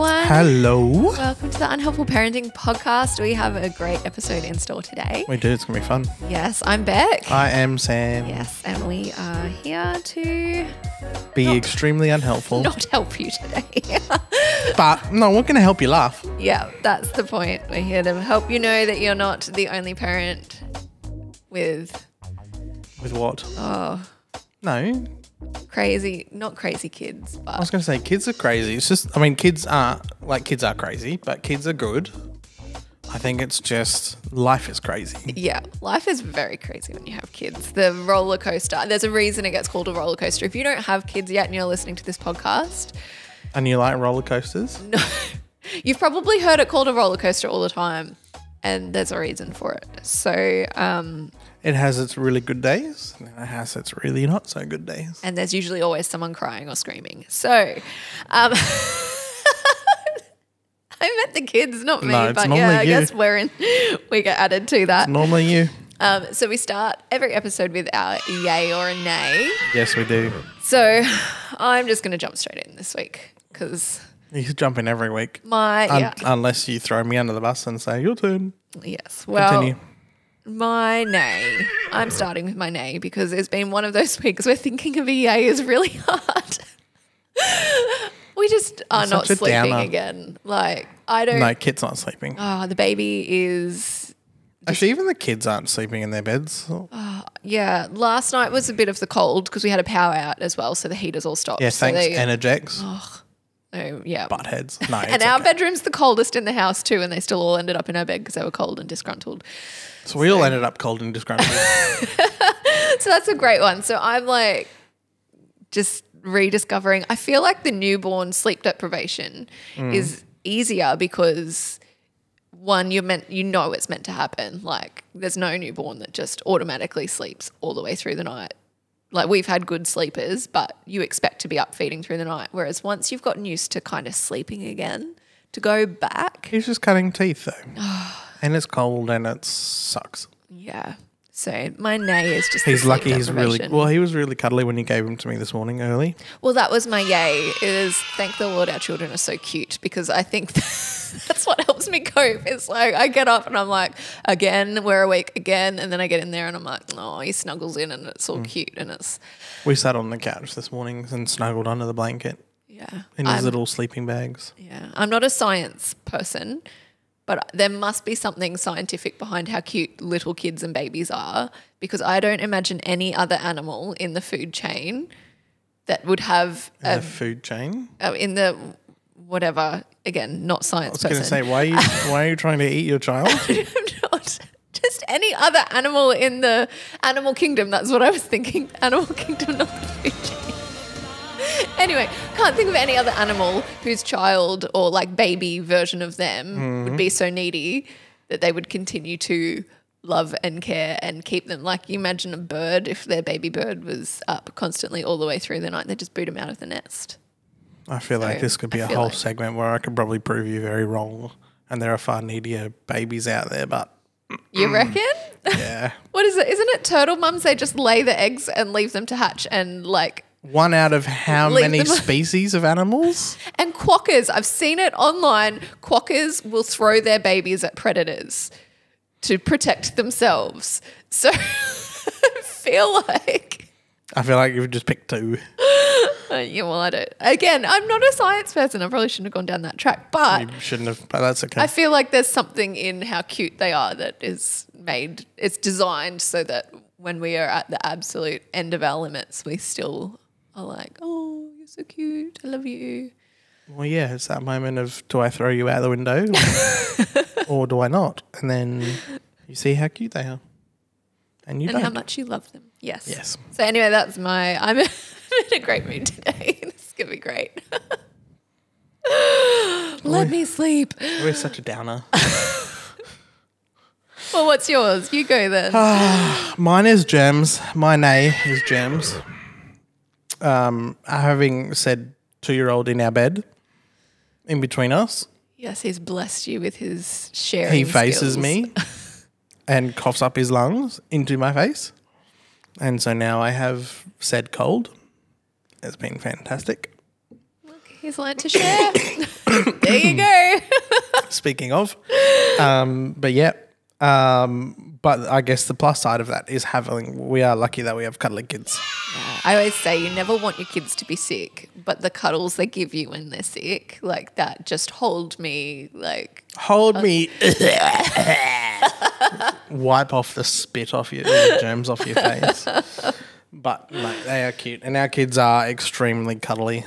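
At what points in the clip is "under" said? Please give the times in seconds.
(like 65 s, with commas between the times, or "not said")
77 s, 161 s.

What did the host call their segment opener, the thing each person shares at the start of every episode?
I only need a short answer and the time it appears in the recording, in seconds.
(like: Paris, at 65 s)
Yay or a nay, at 68 s.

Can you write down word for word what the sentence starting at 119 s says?
is easier because one you're meant you know it's meant to happen.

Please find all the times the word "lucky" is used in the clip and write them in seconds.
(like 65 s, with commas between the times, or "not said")
142 s, 307 s.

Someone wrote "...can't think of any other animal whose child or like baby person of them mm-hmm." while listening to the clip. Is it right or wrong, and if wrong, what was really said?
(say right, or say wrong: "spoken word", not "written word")
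wrong: "version", not "person".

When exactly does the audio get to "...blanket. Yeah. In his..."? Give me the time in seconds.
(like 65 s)
161 s.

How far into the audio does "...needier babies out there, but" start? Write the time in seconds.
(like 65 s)
212 s.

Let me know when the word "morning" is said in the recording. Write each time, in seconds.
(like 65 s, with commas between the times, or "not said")
145 s, 160 s.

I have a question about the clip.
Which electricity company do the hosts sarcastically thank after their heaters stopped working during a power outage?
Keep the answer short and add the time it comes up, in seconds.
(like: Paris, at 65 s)
Energex, at 102 s.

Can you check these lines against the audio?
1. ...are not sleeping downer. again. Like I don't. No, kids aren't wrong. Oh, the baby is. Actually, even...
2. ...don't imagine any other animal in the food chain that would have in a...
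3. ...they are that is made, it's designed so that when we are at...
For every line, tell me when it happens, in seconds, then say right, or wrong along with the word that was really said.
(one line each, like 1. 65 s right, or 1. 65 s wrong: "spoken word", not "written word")
1. 88 s wrong: "sleeping", not "wrong"
2. 172 s right
3. 243 s right.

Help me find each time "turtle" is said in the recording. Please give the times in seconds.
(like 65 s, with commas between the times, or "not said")
216 s.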